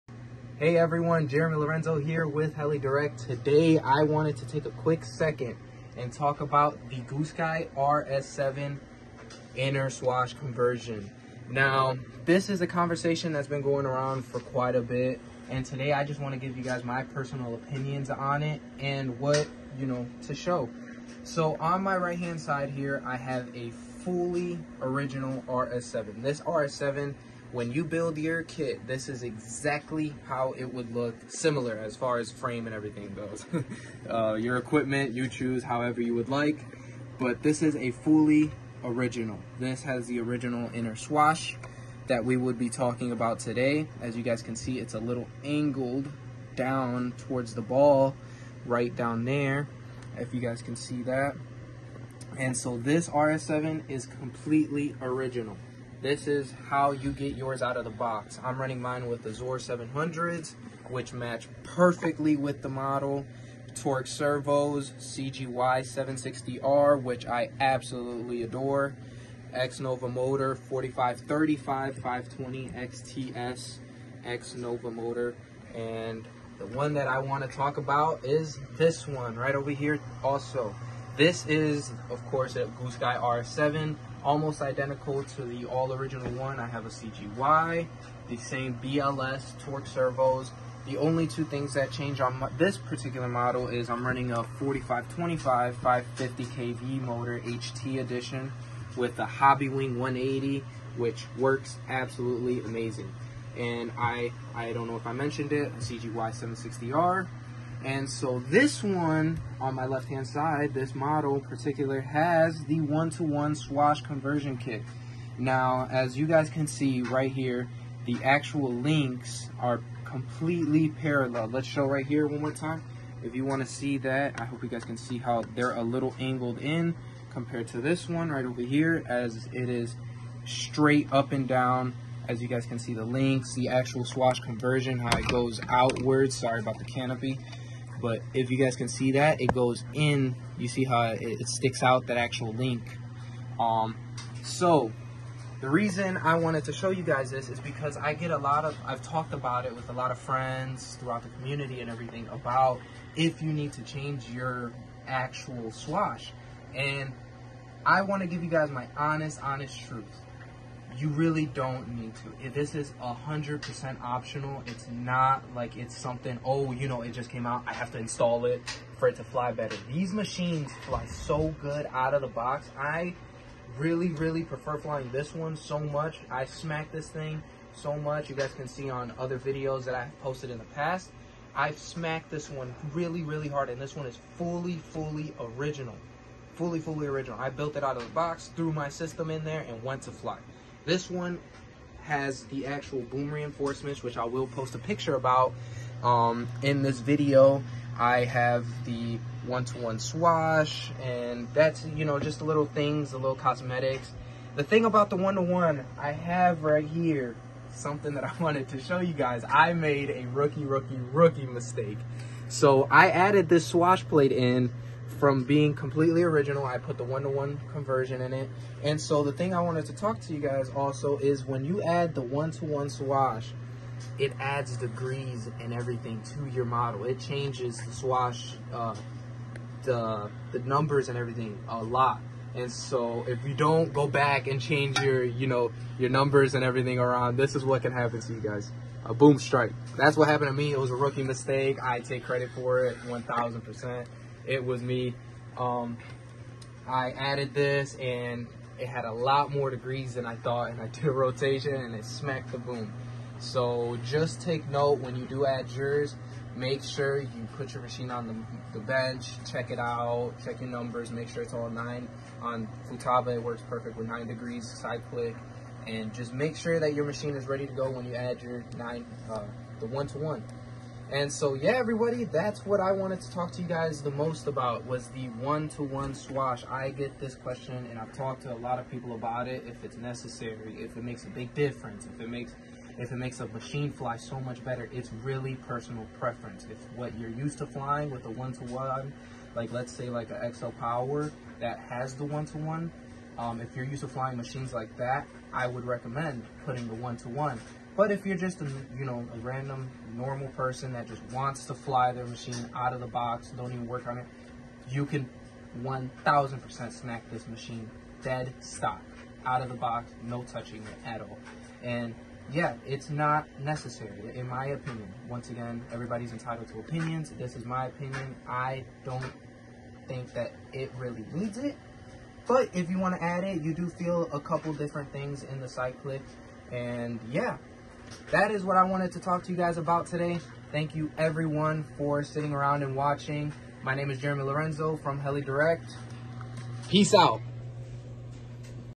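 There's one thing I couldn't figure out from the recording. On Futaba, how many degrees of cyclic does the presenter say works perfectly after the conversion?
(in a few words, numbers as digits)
9.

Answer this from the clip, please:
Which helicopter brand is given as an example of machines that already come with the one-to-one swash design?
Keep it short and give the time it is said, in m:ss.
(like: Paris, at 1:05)
XL Power, at 4:50.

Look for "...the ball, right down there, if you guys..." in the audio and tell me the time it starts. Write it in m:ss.
0:47.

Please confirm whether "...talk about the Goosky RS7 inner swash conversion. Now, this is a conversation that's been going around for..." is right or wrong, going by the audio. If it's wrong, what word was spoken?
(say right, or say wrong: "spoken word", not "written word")
right.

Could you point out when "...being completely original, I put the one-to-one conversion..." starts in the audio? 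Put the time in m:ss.
3:35.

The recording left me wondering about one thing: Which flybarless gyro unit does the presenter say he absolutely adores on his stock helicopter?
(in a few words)
CGY 760R.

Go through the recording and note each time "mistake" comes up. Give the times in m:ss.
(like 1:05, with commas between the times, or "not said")
3:31, 4:01.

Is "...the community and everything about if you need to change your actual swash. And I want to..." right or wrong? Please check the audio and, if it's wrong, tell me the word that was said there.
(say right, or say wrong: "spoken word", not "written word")
right.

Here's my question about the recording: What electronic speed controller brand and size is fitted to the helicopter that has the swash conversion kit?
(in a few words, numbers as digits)
Hobbywing 180.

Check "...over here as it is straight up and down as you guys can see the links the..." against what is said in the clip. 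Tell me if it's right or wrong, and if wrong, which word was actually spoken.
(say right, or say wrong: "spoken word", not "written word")
right.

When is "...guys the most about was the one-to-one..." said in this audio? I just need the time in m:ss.
4:33.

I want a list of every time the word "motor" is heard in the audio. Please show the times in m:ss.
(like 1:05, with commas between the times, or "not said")
1:10, 1:14, 1:37.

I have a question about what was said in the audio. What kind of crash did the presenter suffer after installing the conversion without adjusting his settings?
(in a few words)
A boom strike.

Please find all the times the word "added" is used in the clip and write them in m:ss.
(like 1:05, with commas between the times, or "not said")
3:33, 4:07.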